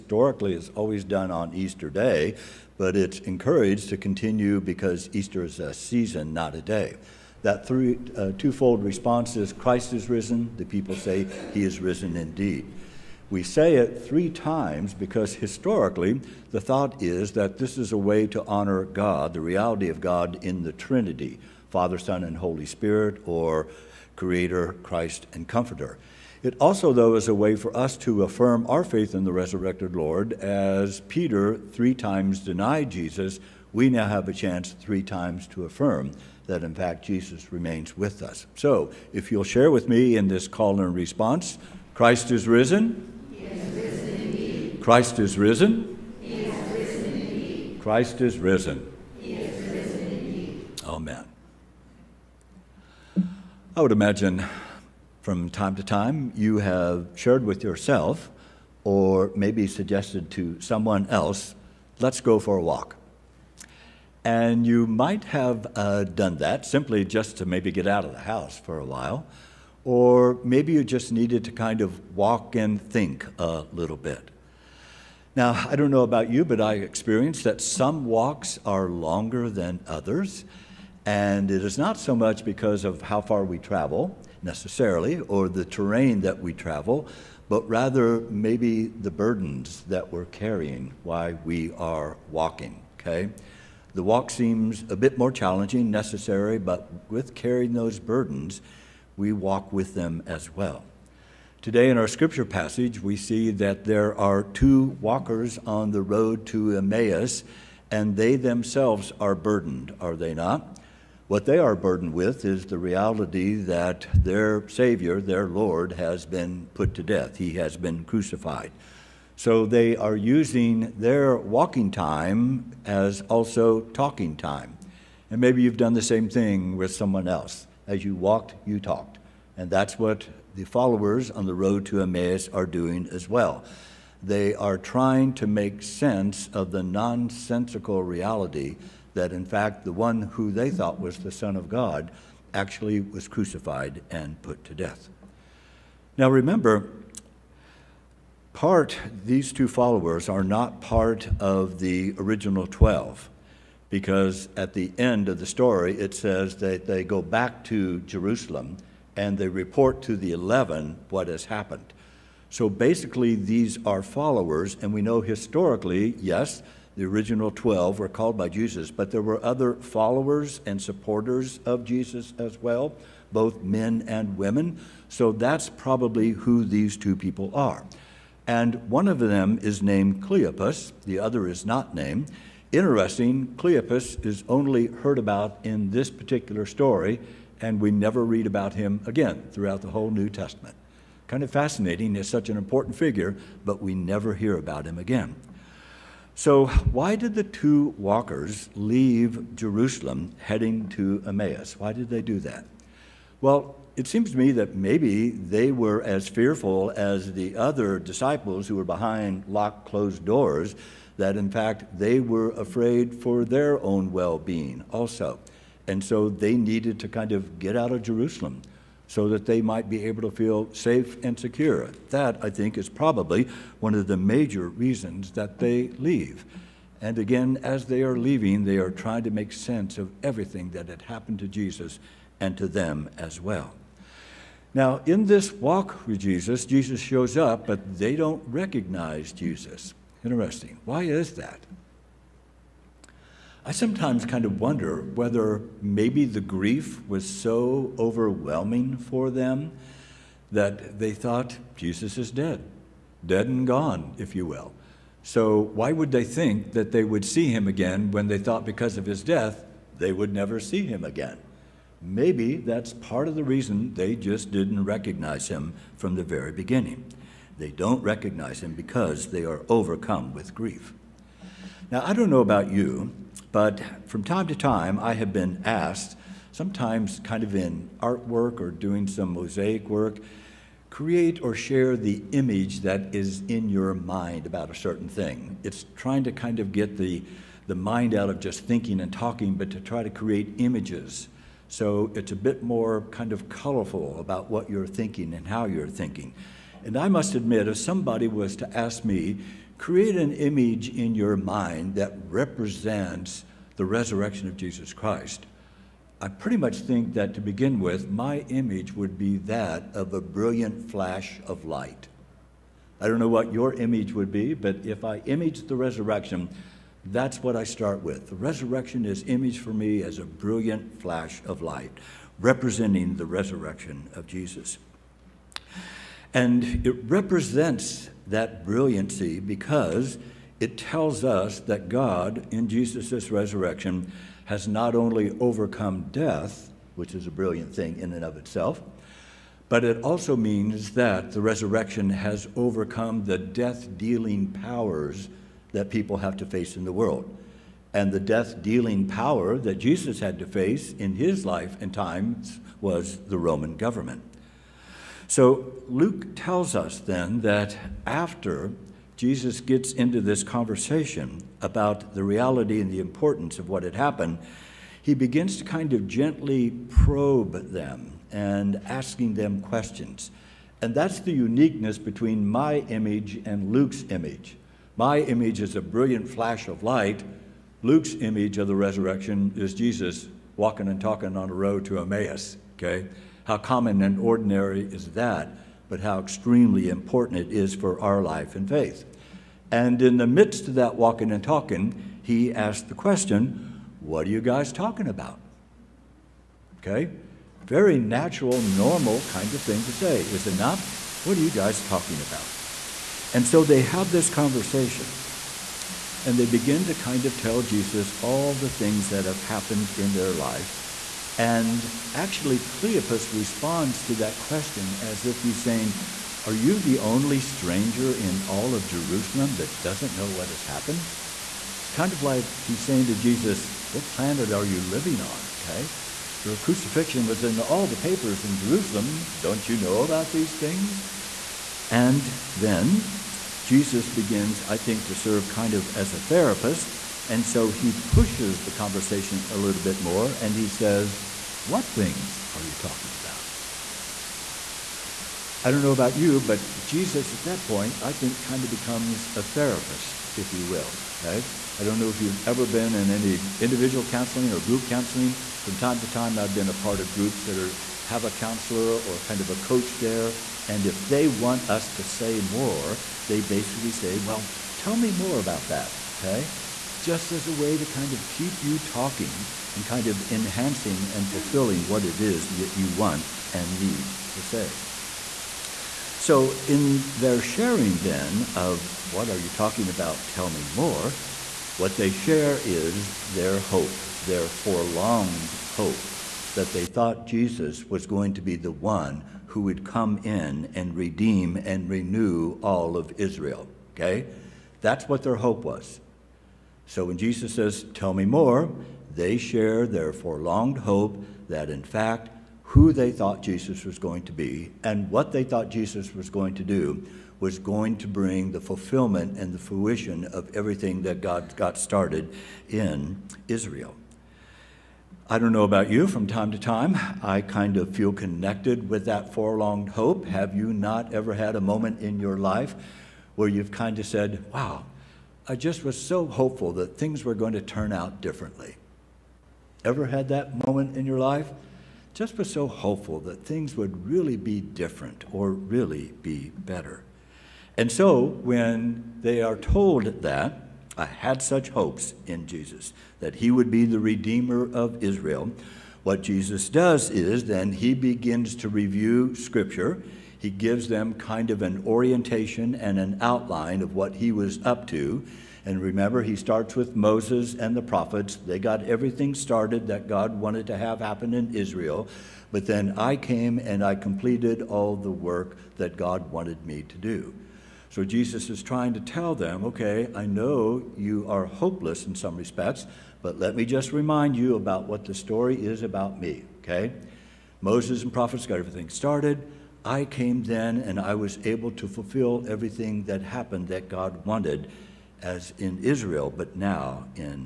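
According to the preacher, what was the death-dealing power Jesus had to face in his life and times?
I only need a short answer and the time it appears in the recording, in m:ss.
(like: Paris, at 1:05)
The Roman government, at 5:53.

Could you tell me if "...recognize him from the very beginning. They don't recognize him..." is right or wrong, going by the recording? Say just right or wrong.
right.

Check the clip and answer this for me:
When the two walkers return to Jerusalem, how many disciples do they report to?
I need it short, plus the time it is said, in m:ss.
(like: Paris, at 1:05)
11, at 2:40.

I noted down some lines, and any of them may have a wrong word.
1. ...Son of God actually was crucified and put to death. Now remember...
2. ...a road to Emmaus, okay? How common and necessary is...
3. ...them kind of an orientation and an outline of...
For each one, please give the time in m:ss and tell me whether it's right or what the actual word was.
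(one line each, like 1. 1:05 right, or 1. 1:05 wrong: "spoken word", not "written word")
1. 2:21 right
2. 6:21 wrong: "ordinary", not "necessary"
3. 9:10 right.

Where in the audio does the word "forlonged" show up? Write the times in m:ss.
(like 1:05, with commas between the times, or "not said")
8:04, 8:20, 8:39.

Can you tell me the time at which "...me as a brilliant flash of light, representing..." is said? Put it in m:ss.
5:19.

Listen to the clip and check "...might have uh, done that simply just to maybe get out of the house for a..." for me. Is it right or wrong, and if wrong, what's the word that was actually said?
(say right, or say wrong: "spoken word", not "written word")
right.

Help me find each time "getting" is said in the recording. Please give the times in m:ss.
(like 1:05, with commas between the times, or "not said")
not said.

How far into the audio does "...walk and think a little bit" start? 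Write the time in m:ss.
1:12.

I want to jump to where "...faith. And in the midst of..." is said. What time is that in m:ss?
6:28.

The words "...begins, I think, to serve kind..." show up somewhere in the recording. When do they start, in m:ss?
7:14.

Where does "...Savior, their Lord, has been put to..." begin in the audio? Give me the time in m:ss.
1:54.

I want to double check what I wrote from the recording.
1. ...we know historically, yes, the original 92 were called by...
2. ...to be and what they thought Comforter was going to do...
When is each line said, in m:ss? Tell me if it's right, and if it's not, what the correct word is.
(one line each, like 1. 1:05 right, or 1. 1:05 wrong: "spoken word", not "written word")
1. 2:44 wrong: "12", not "92"
2. 8:24 wrong: "Jesus", not "Comforter".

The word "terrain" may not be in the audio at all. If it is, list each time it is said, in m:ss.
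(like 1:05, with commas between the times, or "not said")
1:25.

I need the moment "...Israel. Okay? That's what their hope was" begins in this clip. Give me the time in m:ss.
8:13.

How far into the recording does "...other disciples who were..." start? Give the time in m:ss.
3:27.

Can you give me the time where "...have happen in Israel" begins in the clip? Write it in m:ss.
9:20.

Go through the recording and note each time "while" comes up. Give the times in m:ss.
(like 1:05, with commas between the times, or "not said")
1:08, 1:31.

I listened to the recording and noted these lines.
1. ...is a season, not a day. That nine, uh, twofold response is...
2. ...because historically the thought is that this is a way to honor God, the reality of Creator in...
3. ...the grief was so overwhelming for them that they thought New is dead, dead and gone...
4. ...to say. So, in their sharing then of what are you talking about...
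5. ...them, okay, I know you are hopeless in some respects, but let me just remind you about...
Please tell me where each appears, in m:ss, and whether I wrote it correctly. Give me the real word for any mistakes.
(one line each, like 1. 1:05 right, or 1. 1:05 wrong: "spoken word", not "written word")
1. 0:05 wrong: "three", not "nine"
2. 0:14 wrong: "God", not "Creator"
3. 4:06 wrong: "Jesus", not "New"
4. 7:54 right
5. 9:29 right.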